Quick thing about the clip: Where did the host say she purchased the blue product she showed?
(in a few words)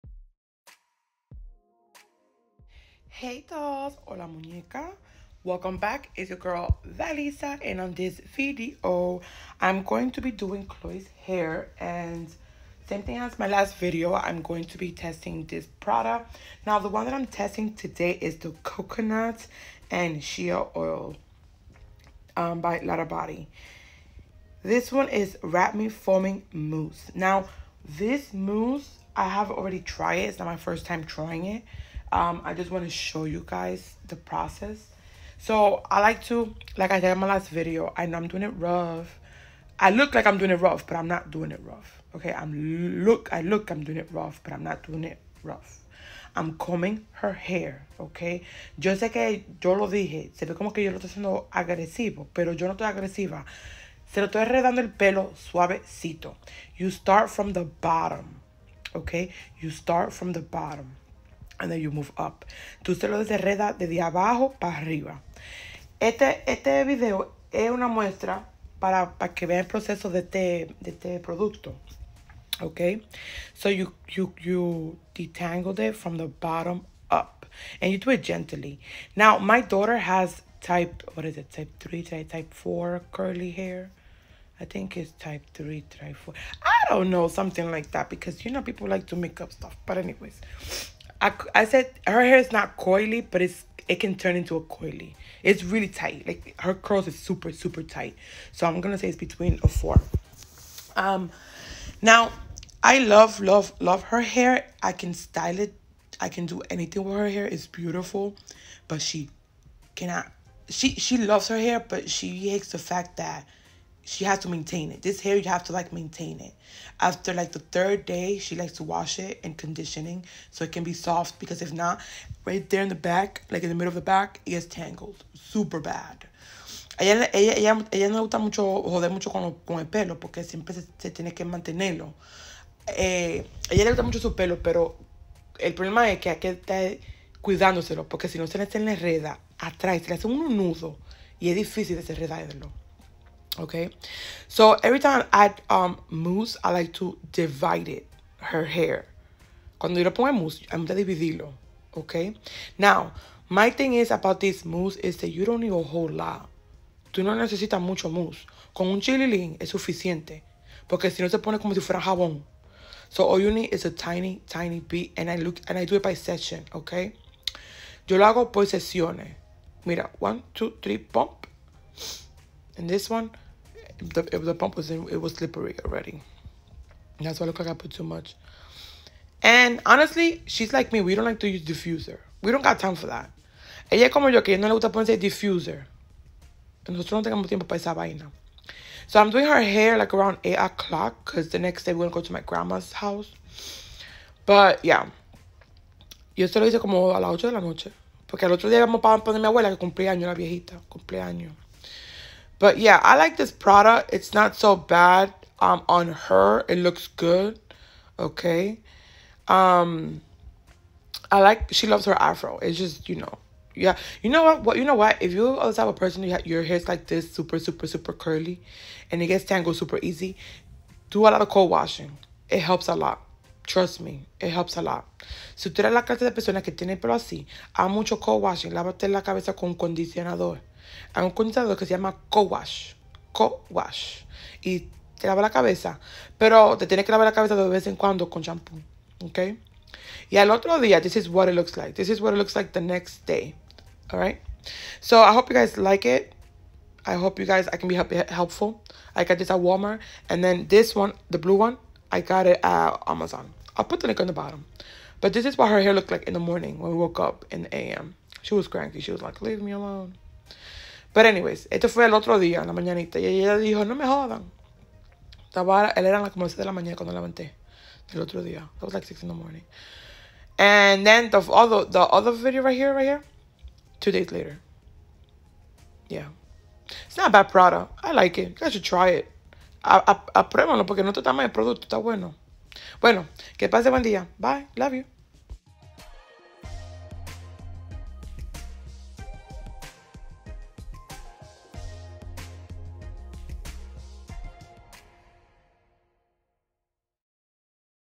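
Amazon.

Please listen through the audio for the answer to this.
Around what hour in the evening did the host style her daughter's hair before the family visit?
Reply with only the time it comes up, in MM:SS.
03:10.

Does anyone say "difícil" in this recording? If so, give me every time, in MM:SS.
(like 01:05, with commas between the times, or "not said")
02:21.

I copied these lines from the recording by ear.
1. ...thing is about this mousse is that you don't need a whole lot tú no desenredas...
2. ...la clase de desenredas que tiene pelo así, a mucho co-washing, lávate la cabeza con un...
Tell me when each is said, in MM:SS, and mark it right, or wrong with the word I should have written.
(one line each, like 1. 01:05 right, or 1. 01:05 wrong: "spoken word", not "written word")
1. 02:33 wrong: "necesitas", not "desenredas"
2. 03:45 wrong: "personas", not "desenredas".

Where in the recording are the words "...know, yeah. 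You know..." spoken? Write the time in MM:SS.
03:33.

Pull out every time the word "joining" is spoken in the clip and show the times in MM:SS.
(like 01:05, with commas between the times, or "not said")
not said.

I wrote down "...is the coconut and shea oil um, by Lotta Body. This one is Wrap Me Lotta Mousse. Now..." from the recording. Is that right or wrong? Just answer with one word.
wrong.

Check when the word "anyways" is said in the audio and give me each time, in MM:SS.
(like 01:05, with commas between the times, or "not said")
01:29, 04:21.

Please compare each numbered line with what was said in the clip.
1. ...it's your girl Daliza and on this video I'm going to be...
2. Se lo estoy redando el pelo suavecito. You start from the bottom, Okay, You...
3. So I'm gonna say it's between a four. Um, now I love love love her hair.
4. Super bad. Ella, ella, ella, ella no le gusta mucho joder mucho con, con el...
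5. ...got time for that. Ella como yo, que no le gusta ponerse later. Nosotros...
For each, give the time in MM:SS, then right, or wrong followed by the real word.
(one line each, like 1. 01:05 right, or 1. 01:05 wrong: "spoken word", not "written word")
1. 00:06 right
2. 00:54 right
3. 01:38 right
4. 02:05 right
5. 03:02 wrong: "diffuser", not "later".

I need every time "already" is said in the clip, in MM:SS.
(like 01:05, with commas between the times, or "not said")
00:29, 02:55.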